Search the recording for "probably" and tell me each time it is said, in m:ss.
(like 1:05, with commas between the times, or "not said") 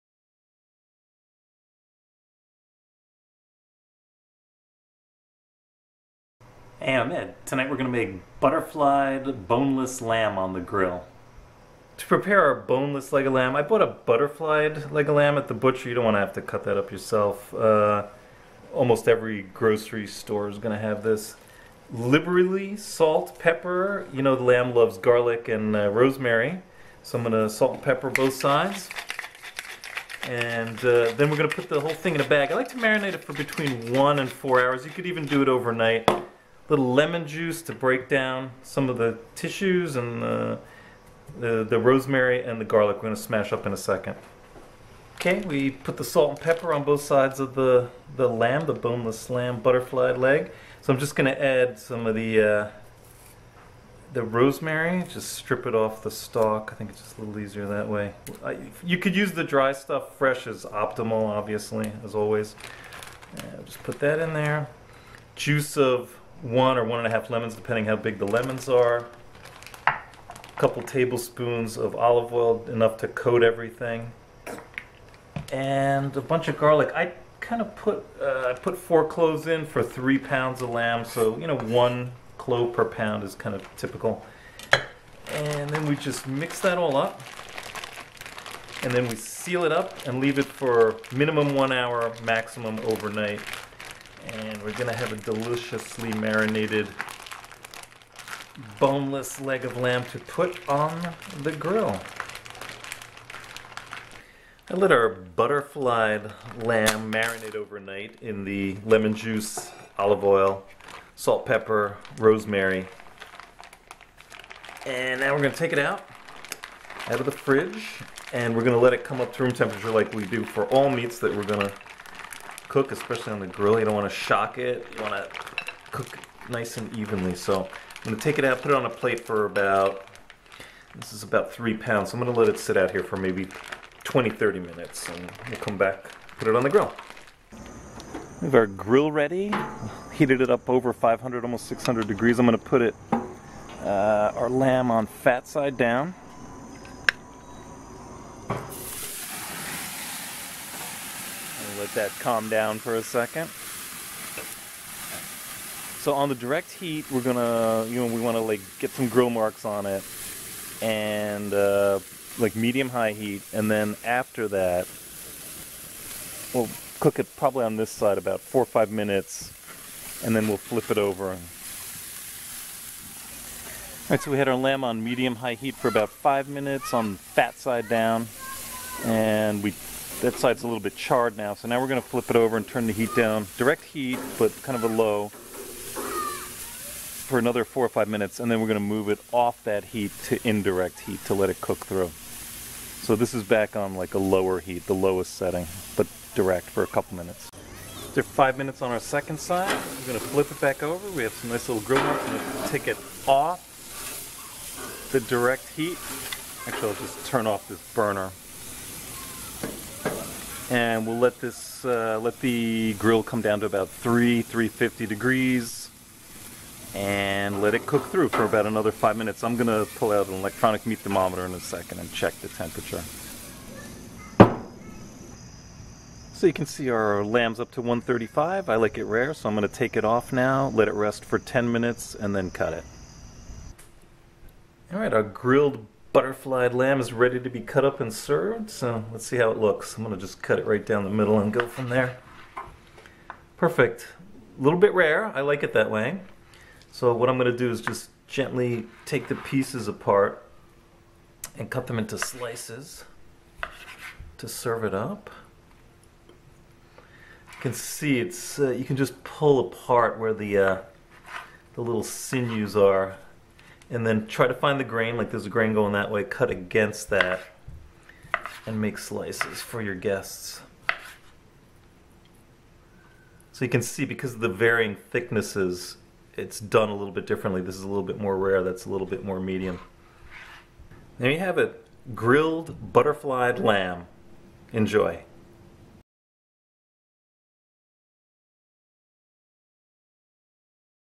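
2:47.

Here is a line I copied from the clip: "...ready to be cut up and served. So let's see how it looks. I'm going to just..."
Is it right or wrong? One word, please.
right.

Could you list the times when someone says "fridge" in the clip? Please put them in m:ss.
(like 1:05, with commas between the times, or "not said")
1:57.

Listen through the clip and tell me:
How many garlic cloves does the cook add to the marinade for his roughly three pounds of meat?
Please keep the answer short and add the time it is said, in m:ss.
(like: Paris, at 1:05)
4, at 1:18.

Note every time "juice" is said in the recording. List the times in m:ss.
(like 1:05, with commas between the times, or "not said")
0:37, 1:05, 1:49.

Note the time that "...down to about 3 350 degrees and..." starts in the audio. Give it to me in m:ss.
3:33.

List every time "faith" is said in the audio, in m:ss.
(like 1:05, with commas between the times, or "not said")
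not said.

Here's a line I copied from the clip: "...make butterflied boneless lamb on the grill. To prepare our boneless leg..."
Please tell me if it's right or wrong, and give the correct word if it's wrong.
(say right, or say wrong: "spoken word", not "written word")
right.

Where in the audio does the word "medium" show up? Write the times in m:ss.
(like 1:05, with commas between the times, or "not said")
2:42, 2:55, 4:39.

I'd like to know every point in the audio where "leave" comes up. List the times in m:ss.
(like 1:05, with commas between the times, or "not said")
1:30.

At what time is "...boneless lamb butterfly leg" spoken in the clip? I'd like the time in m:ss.
0:48.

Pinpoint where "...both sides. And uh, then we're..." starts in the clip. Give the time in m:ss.
0:28.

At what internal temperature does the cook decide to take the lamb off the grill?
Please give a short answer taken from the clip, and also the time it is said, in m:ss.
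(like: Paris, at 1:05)
135, at 3:47.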